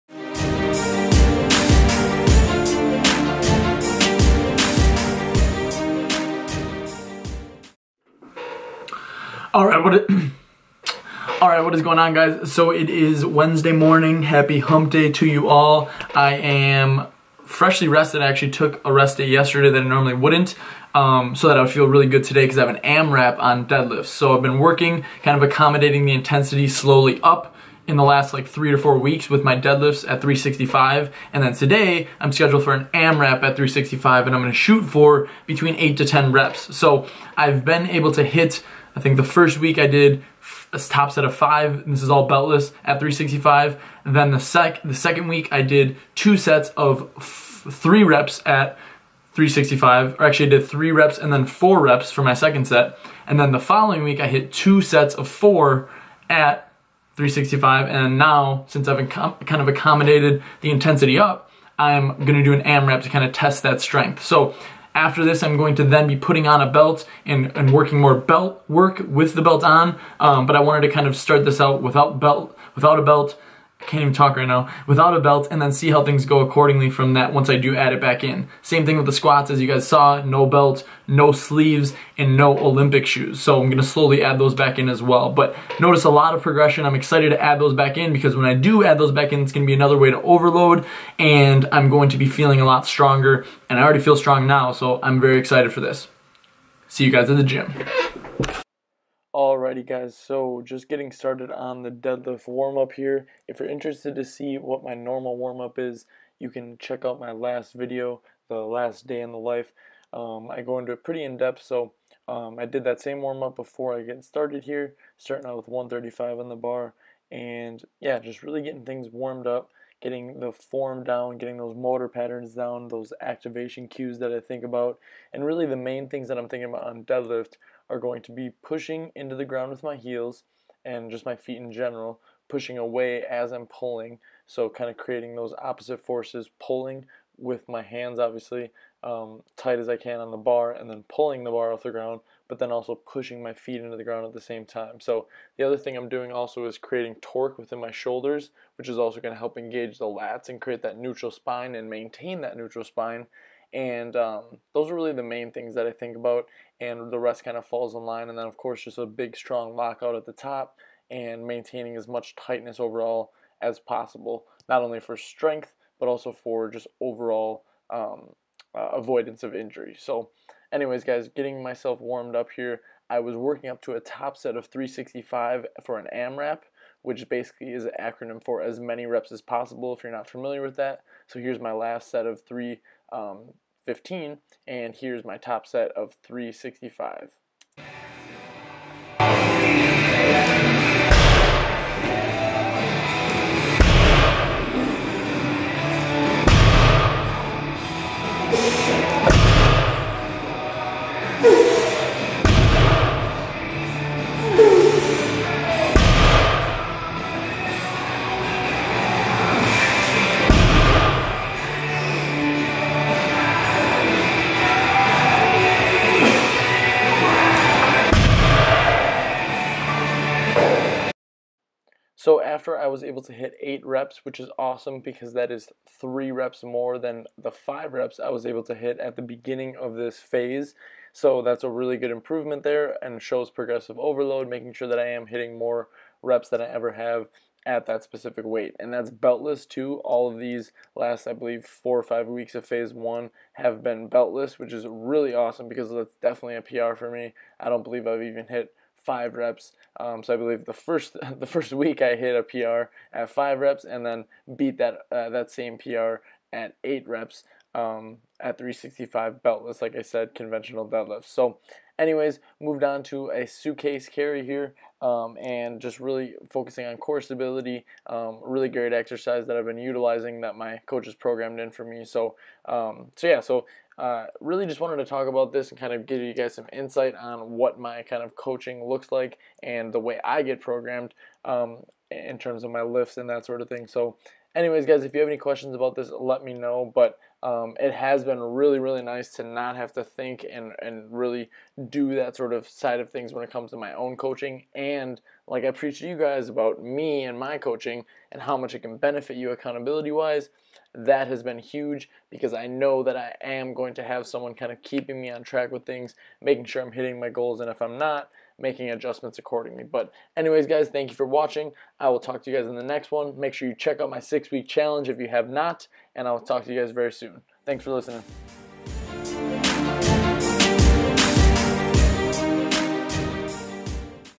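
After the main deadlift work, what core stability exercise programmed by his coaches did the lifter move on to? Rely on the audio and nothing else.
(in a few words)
suitcase carry.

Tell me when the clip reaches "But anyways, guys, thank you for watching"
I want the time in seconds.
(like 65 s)
309 s.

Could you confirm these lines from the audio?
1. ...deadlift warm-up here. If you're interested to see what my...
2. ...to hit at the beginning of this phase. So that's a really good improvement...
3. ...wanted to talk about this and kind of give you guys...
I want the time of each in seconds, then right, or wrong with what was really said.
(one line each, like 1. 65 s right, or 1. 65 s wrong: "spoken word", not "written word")
1. 101 s right
2. 228 s right
3. 274 s right.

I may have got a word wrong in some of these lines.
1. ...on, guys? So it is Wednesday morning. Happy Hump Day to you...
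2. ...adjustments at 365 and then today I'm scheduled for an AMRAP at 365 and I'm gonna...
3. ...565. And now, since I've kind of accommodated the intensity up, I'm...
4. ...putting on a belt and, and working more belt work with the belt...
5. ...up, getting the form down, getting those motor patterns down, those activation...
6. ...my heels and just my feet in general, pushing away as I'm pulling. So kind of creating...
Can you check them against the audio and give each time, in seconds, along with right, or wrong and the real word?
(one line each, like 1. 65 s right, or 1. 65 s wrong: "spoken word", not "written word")
1. 11 s right
2. 29 s wrong: "deadlifts", not "adjustments"
3. 57 s wrong: "365", not "565"
4. 66 s right
5. 119 s right
6. 129 s right.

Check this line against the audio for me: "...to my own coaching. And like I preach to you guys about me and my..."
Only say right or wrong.
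right.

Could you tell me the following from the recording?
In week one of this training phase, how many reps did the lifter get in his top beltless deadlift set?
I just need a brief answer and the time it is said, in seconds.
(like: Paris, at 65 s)
5, at 40 s.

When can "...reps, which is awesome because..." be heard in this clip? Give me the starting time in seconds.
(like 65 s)
223 s.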